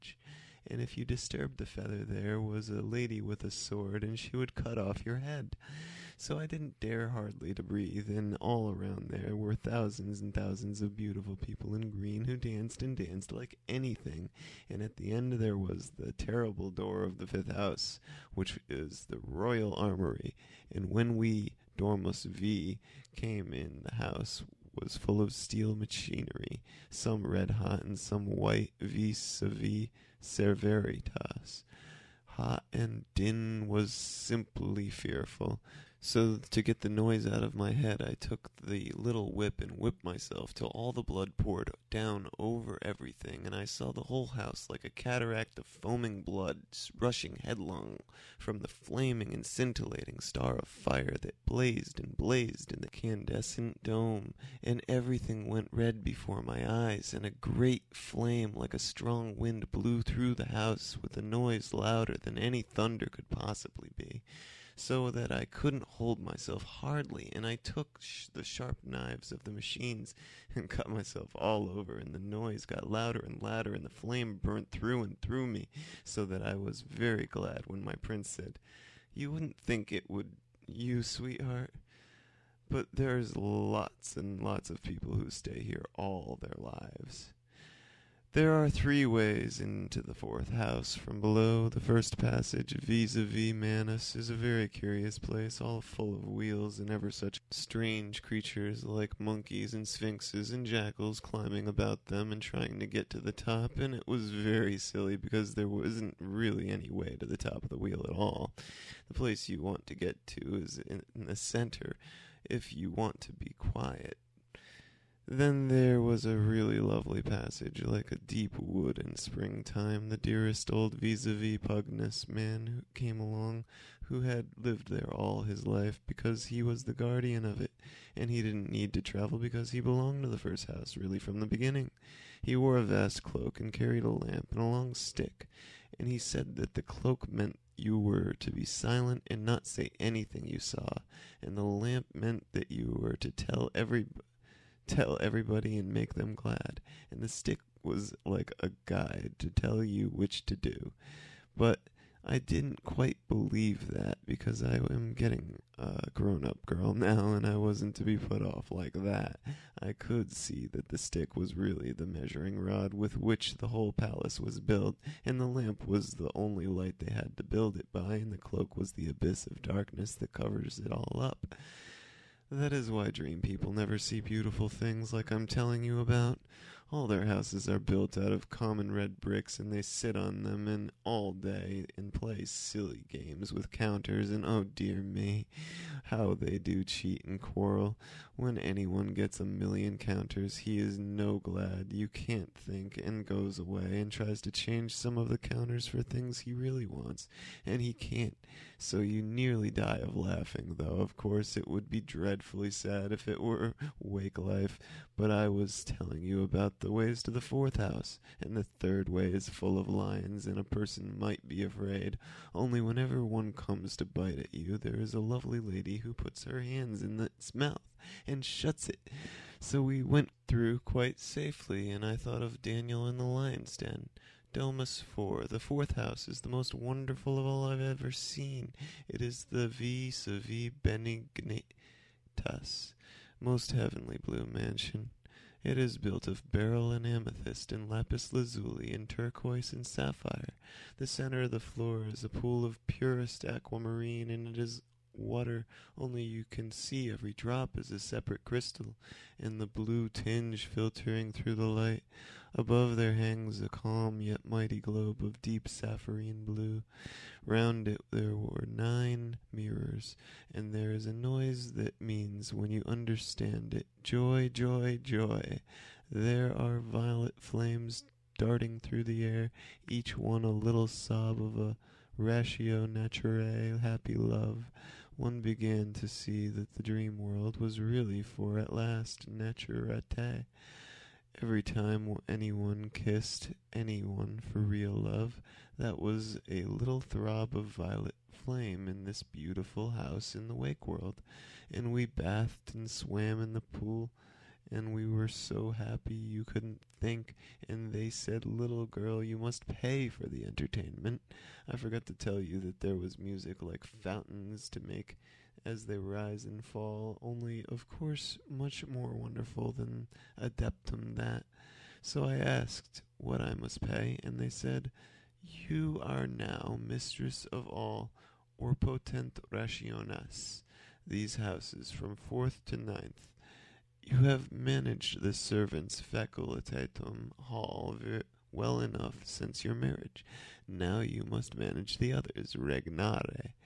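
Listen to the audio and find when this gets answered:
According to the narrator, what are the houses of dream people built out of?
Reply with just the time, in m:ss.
2:58.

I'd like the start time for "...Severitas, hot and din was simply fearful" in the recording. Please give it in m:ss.
0:30.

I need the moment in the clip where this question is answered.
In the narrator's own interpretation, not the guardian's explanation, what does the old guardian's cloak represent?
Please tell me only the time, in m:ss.
2:48.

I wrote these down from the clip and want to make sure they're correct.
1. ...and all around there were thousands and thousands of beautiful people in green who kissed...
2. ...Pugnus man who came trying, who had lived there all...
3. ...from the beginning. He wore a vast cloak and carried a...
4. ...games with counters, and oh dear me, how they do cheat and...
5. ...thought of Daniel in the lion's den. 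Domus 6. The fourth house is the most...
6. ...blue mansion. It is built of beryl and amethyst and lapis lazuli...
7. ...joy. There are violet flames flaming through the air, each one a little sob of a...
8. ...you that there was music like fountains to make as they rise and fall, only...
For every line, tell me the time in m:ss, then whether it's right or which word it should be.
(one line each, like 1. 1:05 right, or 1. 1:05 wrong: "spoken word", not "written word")
1. 0:08 wrong: "danced", not "kissed"
2. 2:01 wrong: "along", not "trying"
3. 2:11 right
4. 3:03 right
5. 3:42 wrong: "4", not "6"
6. 3:54 right
7. 4:25 wrong: "darting", not "flaming"
8. 5:02 right.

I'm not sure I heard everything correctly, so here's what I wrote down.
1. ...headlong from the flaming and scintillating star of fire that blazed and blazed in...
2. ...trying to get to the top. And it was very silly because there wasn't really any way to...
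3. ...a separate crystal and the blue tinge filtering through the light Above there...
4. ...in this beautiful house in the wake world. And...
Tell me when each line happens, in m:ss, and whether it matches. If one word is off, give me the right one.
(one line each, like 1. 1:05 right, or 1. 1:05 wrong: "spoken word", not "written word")
1. 0:47 right
2. 1:42 right
3. 4:07 right
4. 4:48 right.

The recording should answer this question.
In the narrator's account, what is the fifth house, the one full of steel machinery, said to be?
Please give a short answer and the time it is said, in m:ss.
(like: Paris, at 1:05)
The royal armory, at 0:19.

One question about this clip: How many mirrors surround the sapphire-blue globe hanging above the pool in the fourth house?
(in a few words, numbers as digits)
9.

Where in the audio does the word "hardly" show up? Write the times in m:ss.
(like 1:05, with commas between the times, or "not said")
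0:07, 1:06.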